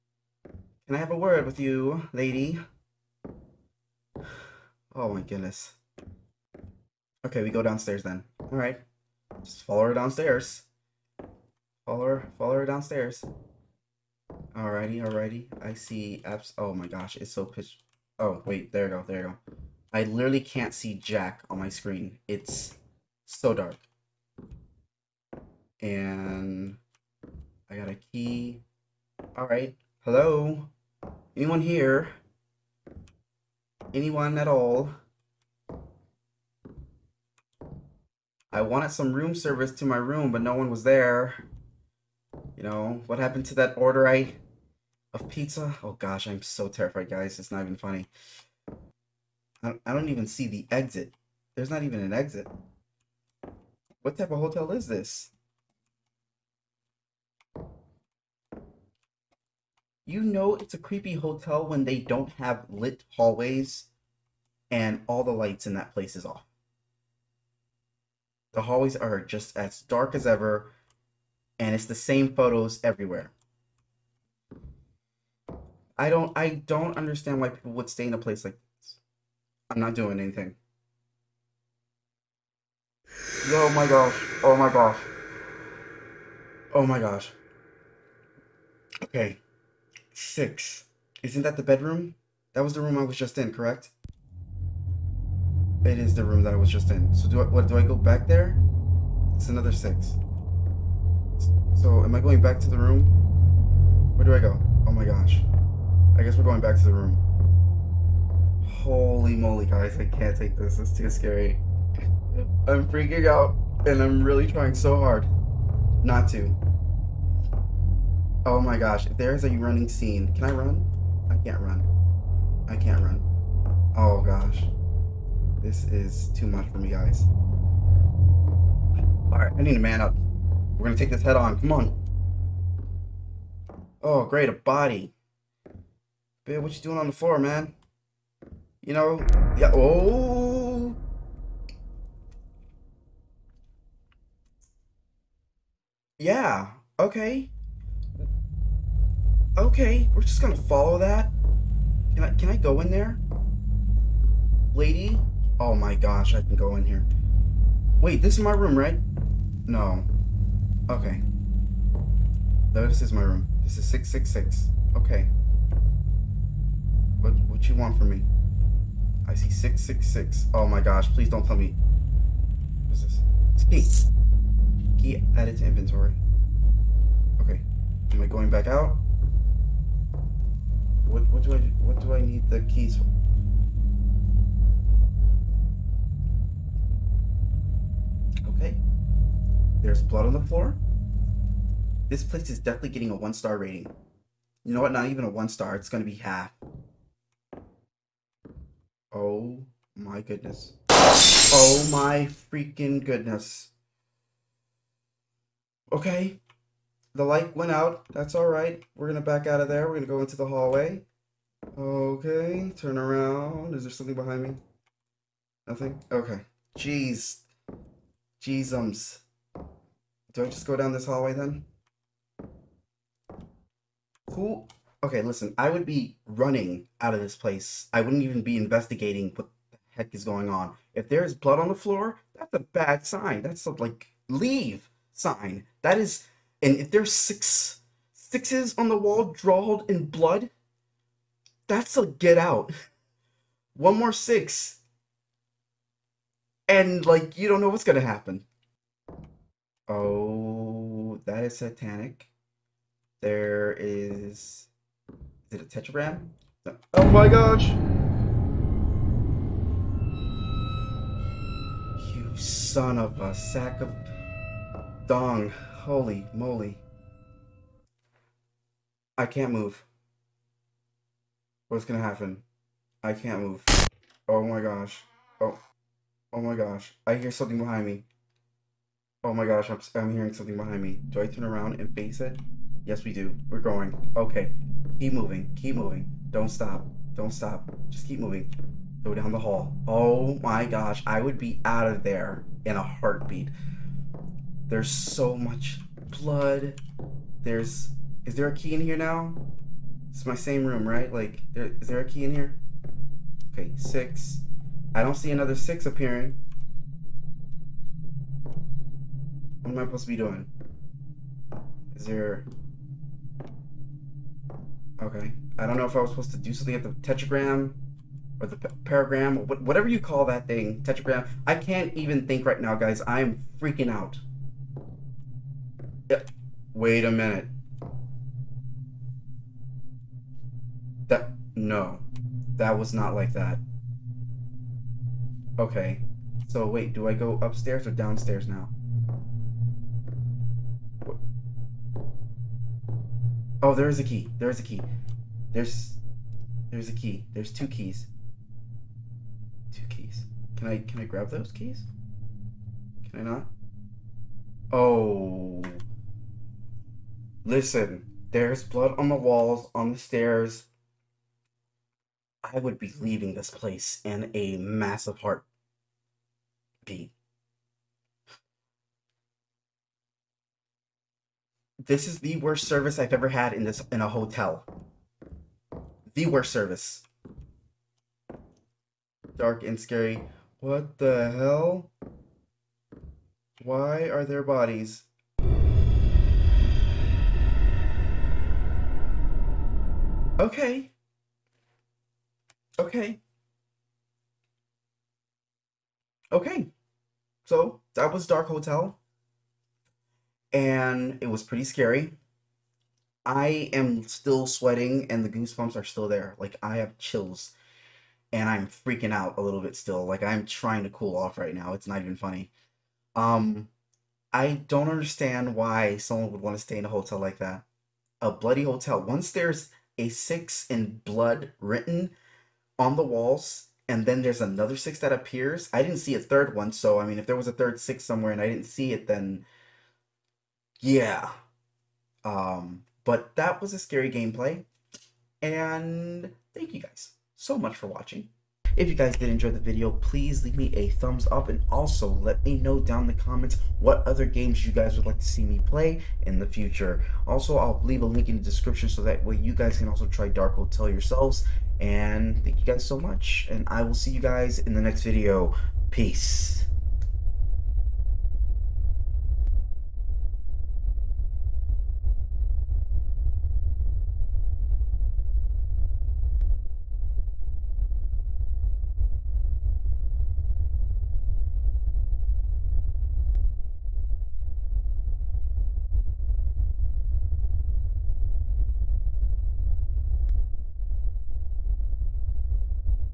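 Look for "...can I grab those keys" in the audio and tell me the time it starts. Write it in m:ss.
5:50.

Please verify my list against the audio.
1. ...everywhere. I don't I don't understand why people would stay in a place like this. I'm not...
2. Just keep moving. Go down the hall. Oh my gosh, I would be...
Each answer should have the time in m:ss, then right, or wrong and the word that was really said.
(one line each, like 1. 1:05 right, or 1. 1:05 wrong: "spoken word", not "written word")
1. 1:12 right
2. 4:47 right.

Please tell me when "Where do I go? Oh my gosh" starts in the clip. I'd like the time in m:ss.
1:44.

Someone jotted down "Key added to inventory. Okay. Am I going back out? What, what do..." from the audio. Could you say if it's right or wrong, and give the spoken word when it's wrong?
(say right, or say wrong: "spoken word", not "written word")
right.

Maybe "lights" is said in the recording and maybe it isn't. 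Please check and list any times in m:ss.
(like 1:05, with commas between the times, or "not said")
1:05, 3:27.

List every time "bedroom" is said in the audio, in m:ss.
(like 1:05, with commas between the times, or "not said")
1:31.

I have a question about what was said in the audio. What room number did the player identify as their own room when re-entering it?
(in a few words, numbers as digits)
666.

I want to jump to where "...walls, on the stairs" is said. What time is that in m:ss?
5:59.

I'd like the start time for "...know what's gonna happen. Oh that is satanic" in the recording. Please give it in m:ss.
4:07.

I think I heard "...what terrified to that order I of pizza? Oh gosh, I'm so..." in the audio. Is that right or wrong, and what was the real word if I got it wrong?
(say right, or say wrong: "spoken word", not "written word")
wrong: "happened", not "terrified".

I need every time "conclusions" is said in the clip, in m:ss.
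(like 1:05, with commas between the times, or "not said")
not said.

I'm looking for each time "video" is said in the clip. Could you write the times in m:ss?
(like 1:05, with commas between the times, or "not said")
7:19, 7:35.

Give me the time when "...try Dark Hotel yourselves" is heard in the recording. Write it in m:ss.
7:30.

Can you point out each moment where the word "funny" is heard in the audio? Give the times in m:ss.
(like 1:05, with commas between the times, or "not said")
0:47, 6:52.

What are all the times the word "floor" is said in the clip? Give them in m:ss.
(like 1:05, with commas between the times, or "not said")
2:17, 3:10, 3:51.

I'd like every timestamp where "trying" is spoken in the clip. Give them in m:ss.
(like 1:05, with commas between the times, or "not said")
1:54, 6:50.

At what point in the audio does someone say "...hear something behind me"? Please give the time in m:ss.
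4:37.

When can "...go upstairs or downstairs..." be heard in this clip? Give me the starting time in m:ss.
5:37.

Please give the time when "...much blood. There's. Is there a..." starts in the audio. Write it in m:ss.
4:55.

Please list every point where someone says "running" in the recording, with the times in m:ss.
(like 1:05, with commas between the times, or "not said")
1:59, 3:46.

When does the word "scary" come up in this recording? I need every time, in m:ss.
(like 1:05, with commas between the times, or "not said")
1:51, 6:19, 6:41, 7:13.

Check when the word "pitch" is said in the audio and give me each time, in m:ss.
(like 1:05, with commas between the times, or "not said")
0:17.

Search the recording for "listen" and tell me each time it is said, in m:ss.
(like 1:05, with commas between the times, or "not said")
3:45, 5:57.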